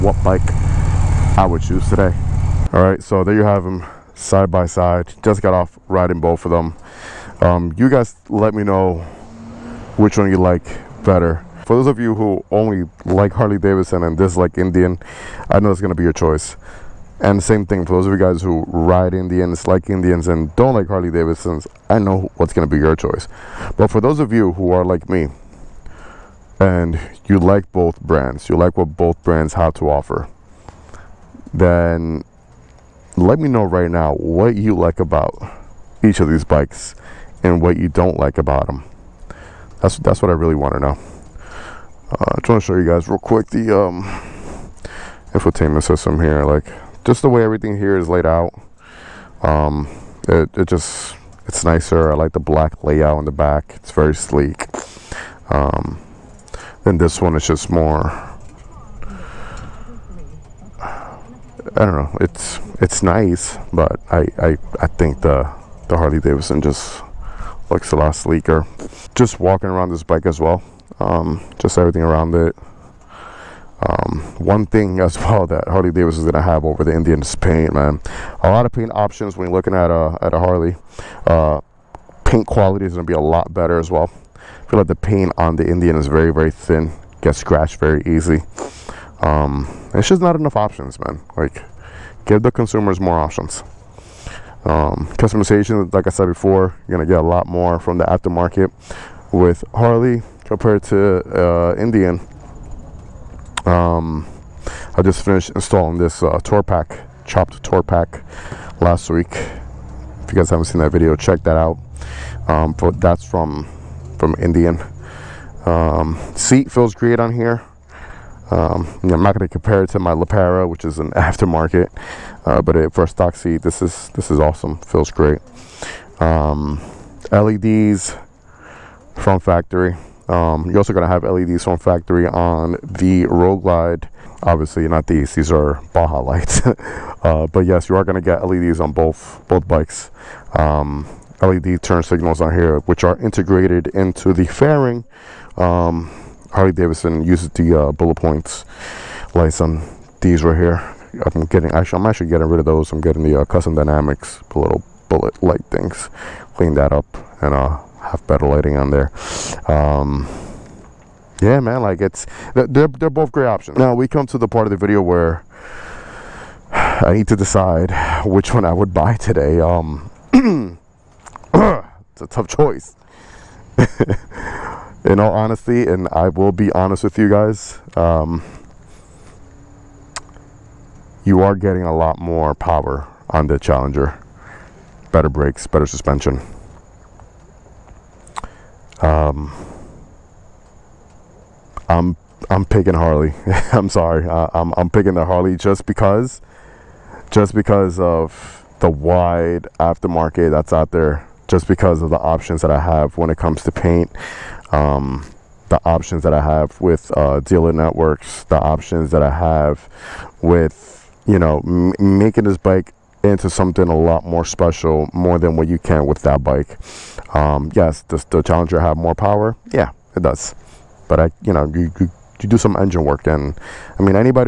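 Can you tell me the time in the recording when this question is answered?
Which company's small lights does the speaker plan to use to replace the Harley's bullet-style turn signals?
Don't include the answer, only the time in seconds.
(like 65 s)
153 s.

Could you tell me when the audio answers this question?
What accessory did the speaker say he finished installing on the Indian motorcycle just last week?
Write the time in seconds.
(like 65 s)
107 s.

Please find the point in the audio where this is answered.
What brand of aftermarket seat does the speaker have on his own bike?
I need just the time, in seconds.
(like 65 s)
120 s.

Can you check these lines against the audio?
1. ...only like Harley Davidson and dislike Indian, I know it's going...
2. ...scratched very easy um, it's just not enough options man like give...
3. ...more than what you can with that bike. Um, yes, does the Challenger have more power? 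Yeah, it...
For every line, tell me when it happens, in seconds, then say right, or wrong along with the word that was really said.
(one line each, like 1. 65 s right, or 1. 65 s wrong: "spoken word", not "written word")
1. 12 s right
2. 87 s right
3. 215 s right.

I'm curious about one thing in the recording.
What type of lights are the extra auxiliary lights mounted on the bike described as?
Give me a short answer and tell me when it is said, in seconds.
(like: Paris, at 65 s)
Baja lights, at 135 s.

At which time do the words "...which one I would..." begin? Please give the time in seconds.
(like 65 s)
168 s.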